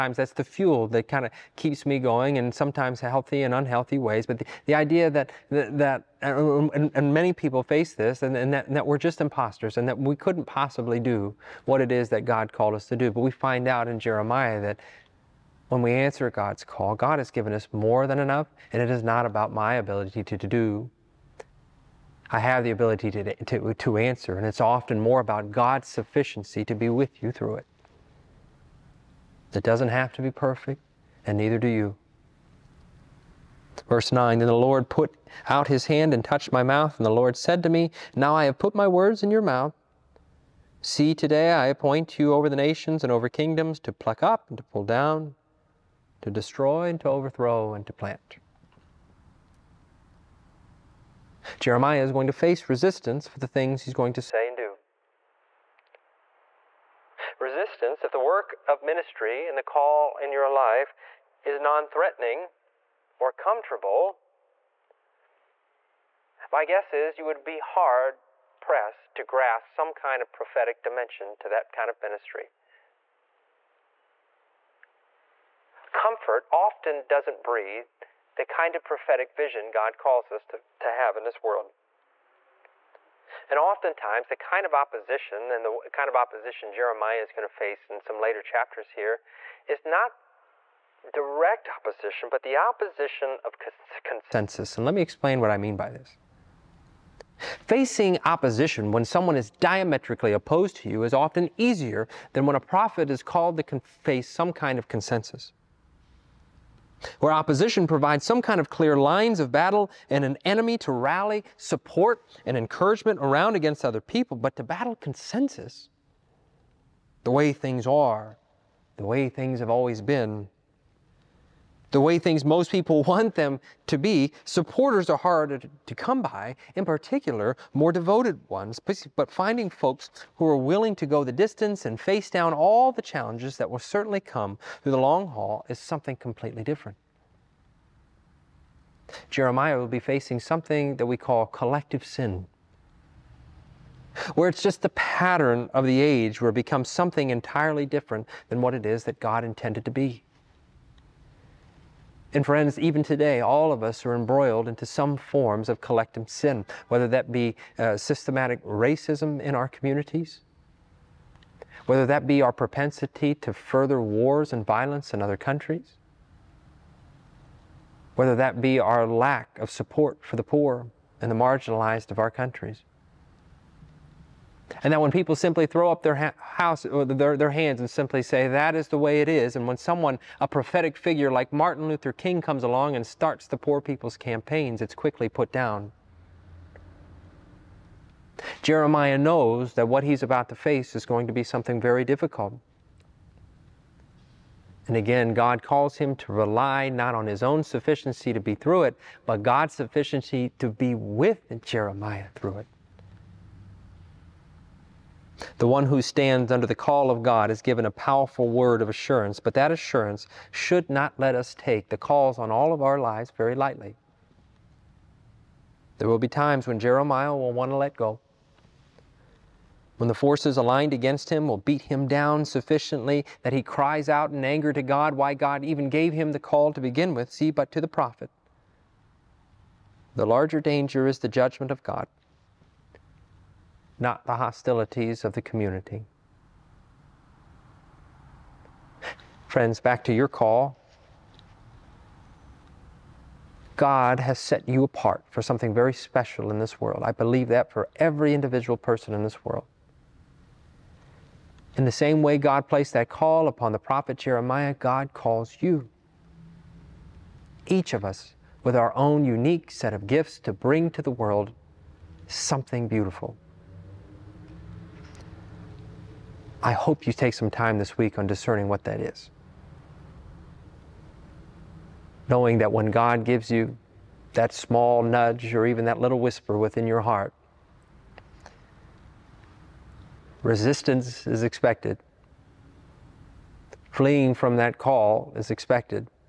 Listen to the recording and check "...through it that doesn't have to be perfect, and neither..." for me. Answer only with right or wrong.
right.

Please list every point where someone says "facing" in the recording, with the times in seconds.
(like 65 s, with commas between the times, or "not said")
97 s, 139 s.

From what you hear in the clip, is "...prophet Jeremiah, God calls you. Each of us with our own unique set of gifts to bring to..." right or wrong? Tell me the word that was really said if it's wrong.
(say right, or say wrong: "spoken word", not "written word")
right.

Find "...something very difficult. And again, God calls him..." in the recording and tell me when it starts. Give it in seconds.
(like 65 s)
191 s.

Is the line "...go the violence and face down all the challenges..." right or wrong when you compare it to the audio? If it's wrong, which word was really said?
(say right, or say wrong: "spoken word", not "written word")
wrong: "distance", not "violence".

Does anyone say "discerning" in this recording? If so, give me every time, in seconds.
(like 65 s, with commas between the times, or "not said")
268 s.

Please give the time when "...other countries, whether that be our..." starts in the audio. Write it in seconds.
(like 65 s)
165 s.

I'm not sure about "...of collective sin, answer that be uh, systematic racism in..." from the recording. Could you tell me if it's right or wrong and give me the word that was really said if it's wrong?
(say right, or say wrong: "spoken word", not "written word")
wrong: "whether", not "answer".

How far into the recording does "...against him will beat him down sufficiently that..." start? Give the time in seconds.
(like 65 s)
220 s.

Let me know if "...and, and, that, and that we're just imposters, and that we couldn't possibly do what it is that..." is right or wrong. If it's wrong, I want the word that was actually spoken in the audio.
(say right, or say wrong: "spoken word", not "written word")
right.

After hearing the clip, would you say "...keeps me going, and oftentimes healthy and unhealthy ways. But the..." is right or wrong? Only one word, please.
wrong.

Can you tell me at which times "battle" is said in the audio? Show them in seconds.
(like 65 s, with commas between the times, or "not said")
109 s, 114 s.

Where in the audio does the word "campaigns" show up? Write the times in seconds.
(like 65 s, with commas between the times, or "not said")
184 s.